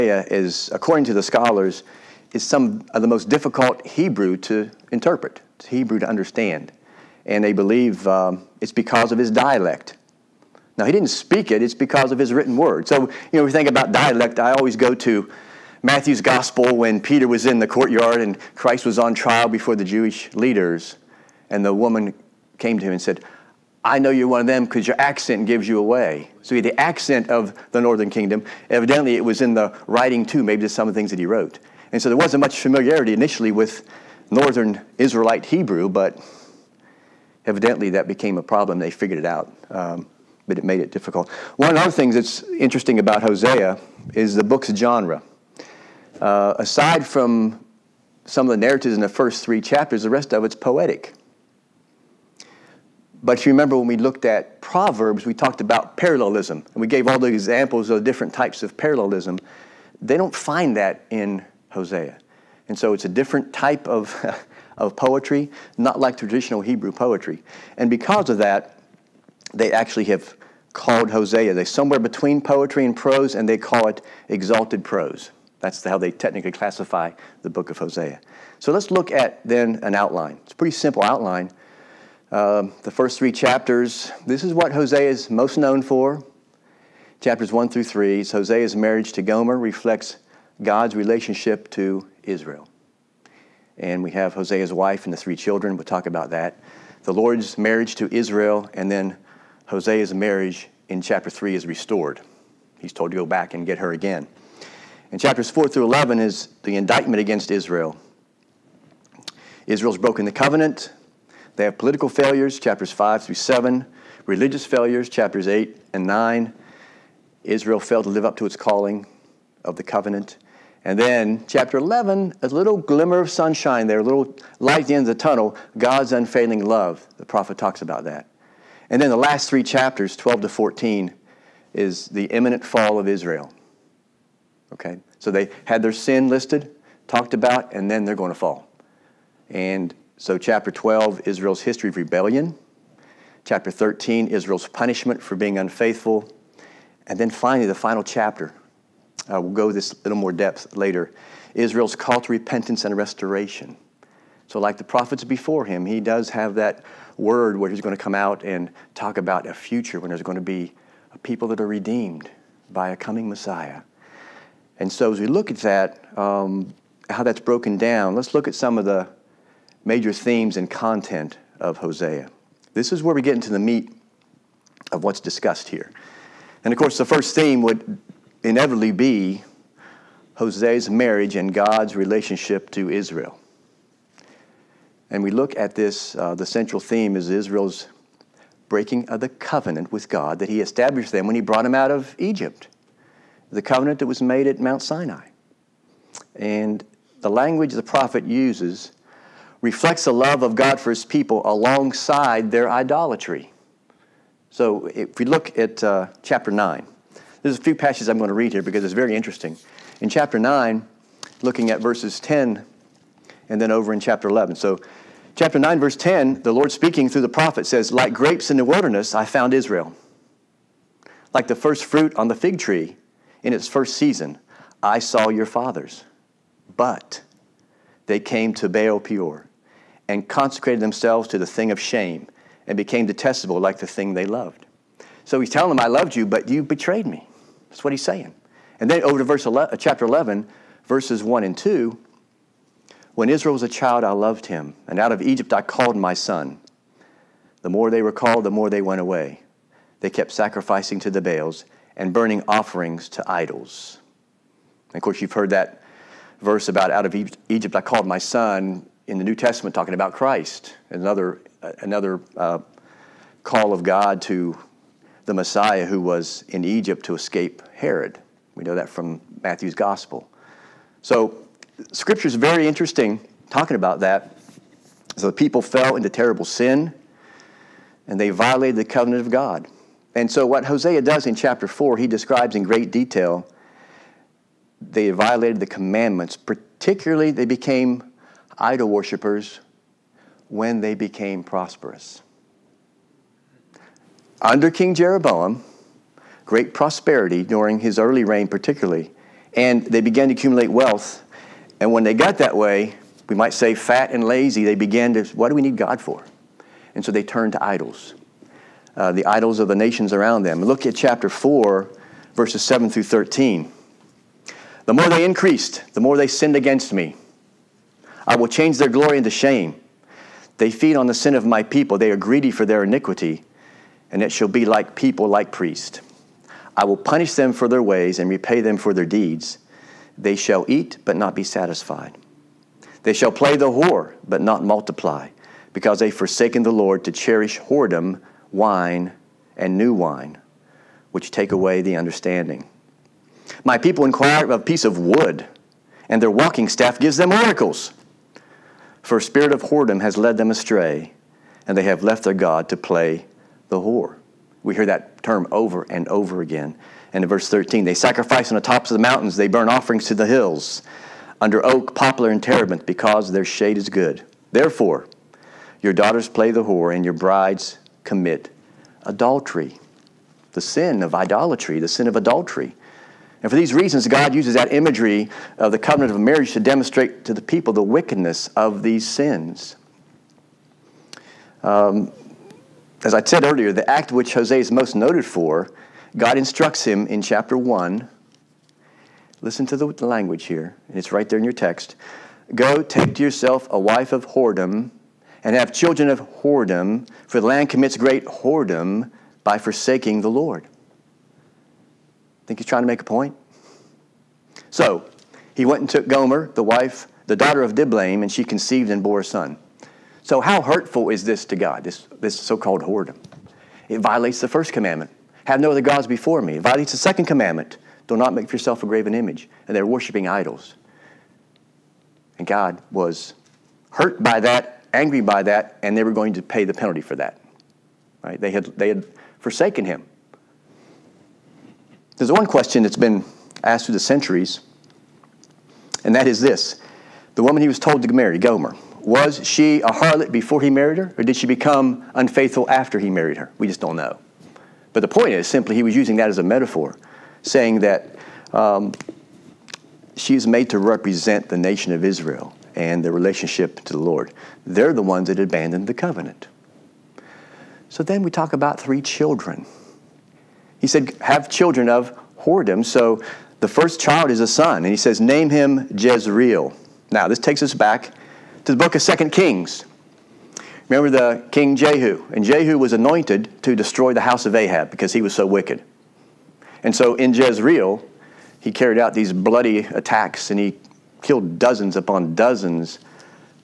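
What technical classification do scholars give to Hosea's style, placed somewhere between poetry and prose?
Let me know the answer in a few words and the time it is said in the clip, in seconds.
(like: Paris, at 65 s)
Exalted prose, at 74 s.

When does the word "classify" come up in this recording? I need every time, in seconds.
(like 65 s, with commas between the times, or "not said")
76 s.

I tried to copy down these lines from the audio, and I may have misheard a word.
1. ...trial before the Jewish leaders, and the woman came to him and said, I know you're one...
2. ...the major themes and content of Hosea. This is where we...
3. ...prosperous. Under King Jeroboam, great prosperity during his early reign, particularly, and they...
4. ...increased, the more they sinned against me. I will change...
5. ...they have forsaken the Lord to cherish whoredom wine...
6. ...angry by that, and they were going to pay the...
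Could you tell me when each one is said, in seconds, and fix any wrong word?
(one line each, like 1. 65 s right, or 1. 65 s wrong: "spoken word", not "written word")
1. 19 s right
2. 168 s right
3. 291 s right
4. 315 s right
5. 336 s right
6. 424 s right.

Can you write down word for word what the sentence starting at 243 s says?
When Israel was a child, I loved him, and out of Egypt I called my son.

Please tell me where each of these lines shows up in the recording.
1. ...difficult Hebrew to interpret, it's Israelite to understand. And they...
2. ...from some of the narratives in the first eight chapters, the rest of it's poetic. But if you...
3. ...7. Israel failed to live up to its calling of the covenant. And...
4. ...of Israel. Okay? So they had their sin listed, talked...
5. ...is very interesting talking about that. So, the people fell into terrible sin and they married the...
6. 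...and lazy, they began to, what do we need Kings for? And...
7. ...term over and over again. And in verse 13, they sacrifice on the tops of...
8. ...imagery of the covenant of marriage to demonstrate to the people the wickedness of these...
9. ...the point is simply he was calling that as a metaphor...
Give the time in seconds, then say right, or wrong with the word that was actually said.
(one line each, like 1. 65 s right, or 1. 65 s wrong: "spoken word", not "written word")
1. 3 s wrong: "Hebrew", not "Israelite"
2. 47 s wrong: "three", not "eight"
3. 116 s wrong: "9", not "7"
4. 132 s right
5. 272 s wrong: "violated", not "married"
6. 304 s wrong: "God", not "Kings"
7. 355 s right
8. 374 s right
9. 445 s wrong: "using", not "calling".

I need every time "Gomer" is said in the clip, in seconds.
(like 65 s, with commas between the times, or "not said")
89 s, 406 s, 438 s.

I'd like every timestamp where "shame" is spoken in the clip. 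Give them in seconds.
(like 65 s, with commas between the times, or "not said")
231 s, 319 s.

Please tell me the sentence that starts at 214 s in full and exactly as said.
So, chapter 9, verse 10, the Lord speaking through the prophet says, Like grapes in the wilderness, I found Israel.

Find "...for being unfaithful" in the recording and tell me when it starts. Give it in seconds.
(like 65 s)
145 s.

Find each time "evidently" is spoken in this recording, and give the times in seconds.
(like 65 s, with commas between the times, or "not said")
28 s, 37 s.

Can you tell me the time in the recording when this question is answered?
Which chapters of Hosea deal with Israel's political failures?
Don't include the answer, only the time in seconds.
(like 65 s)
112 s.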